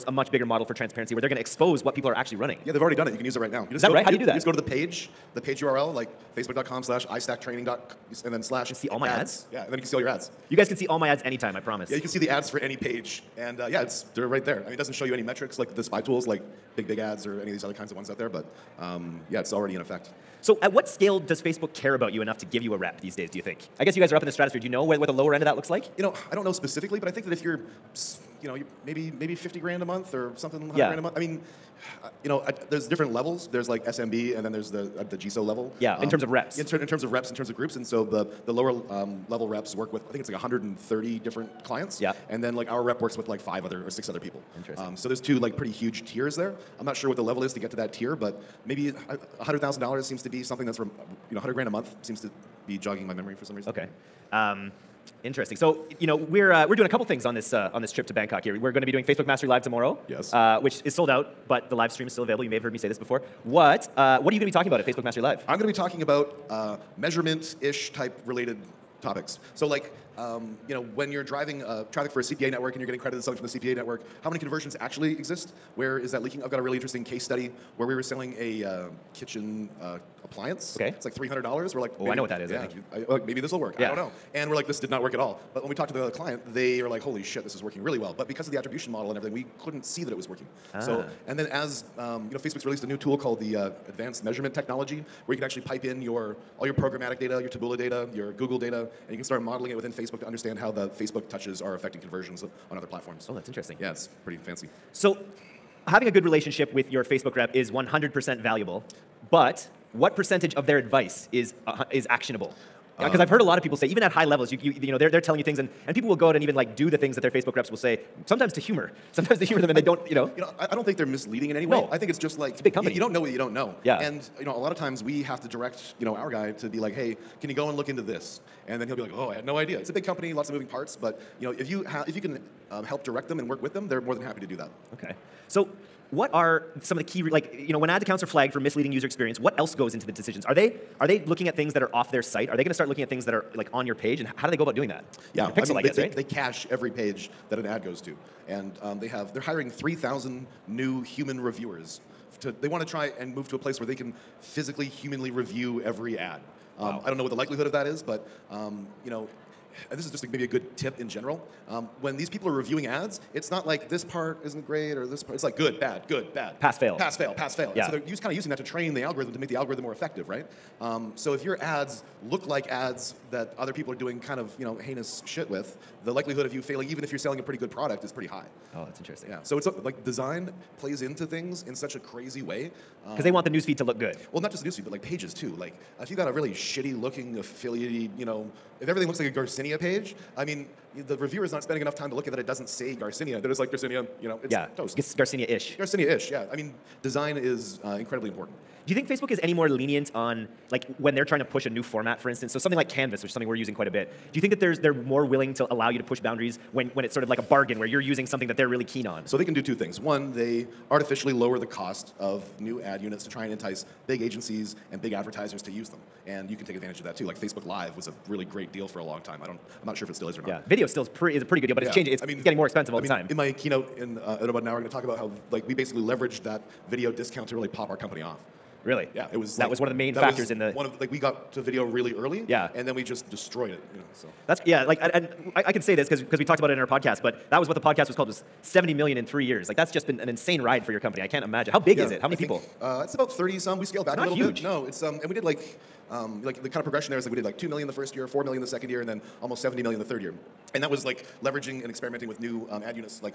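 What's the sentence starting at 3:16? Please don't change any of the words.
I mean, design is uh, incredibly important.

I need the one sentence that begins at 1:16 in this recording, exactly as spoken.
I've got a really interesting case study where we were selling a uh, kitchen uh, appliance.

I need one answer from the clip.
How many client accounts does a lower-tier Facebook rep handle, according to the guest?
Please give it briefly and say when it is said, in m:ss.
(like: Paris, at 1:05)
130, at 0:40.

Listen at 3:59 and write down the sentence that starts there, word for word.
Like that's just been an insane ride for your company.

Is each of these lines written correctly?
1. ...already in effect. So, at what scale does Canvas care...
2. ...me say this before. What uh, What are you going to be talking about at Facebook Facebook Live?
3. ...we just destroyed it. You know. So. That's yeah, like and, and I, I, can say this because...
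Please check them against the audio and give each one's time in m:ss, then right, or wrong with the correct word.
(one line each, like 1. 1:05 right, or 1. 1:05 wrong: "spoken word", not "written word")
1. 0:19 wrong: "Facebook", not "Canvas"
2. 1:02 wrong: "Mastery", not "Facebook"
3. 3:52 right.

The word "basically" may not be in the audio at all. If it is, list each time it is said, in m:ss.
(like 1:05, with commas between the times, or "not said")
3:45.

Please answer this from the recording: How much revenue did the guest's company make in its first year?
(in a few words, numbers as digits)
2 million.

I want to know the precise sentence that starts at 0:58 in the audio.
Here, we're going to be doing Facebook Mastery Live tomorrow.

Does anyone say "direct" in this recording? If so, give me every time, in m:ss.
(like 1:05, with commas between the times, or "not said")
2:05, 2:13.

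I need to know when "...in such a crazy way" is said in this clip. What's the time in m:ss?
3:01.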